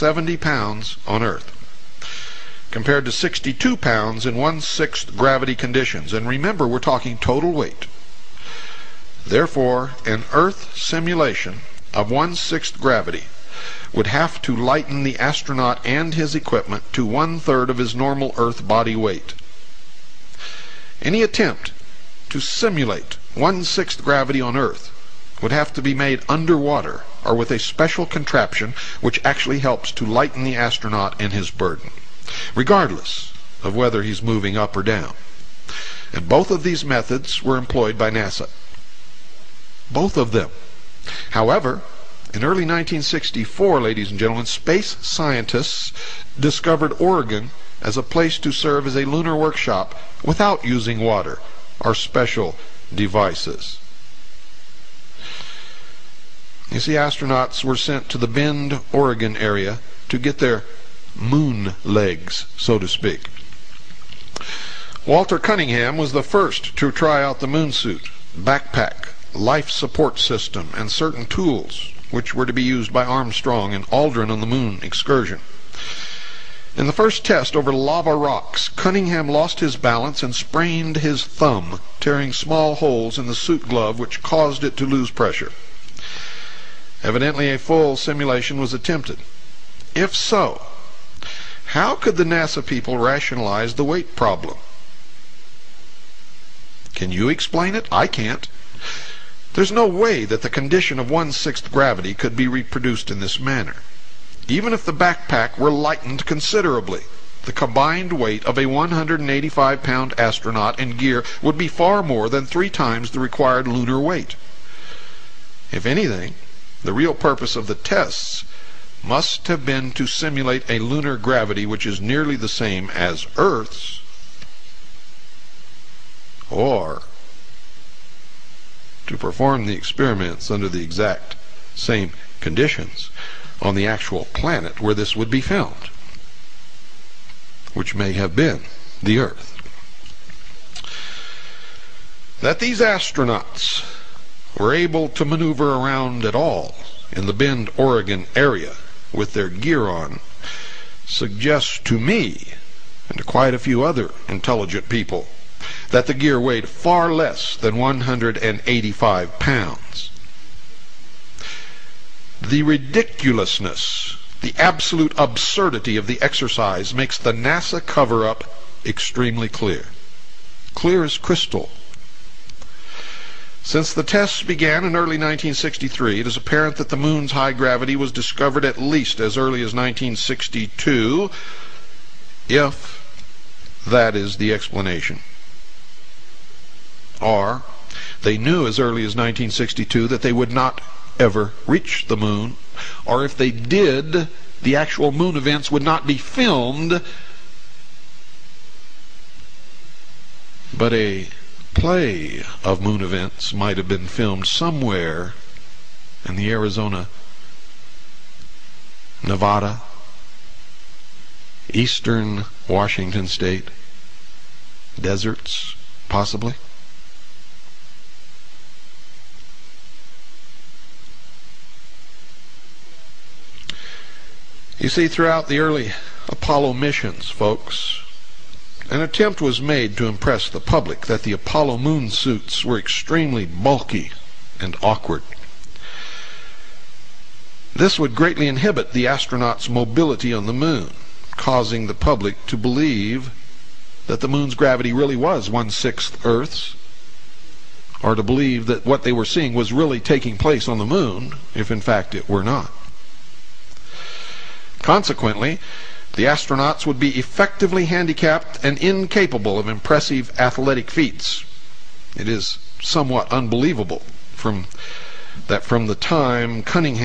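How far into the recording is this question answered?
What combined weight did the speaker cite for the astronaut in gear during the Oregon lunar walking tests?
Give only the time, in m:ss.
1:48.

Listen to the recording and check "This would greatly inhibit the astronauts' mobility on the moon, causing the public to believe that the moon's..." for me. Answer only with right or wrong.
right.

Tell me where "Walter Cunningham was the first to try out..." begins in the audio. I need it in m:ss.
1:05.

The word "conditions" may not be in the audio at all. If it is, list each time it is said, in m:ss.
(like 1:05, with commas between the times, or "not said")
0:05, 1:40, 2:12.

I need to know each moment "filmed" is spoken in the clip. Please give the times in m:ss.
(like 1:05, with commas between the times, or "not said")
3:16, 3:24.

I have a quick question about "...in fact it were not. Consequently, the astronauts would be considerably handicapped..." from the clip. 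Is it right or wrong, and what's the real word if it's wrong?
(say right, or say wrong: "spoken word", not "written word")
wrong: "effectively", not "considerably".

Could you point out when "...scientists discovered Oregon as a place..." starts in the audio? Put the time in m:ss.
0:45.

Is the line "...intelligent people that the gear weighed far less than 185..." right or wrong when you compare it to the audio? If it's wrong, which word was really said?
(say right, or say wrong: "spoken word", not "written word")
right.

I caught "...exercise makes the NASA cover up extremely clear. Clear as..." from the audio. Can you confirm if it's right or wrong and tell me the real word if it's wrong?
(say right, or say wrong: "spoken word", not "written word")
right.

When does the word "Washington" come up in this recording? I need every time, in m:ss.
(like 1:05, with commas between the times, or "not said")
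3:32.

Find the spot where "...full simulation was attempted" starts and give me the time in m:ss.
1:27.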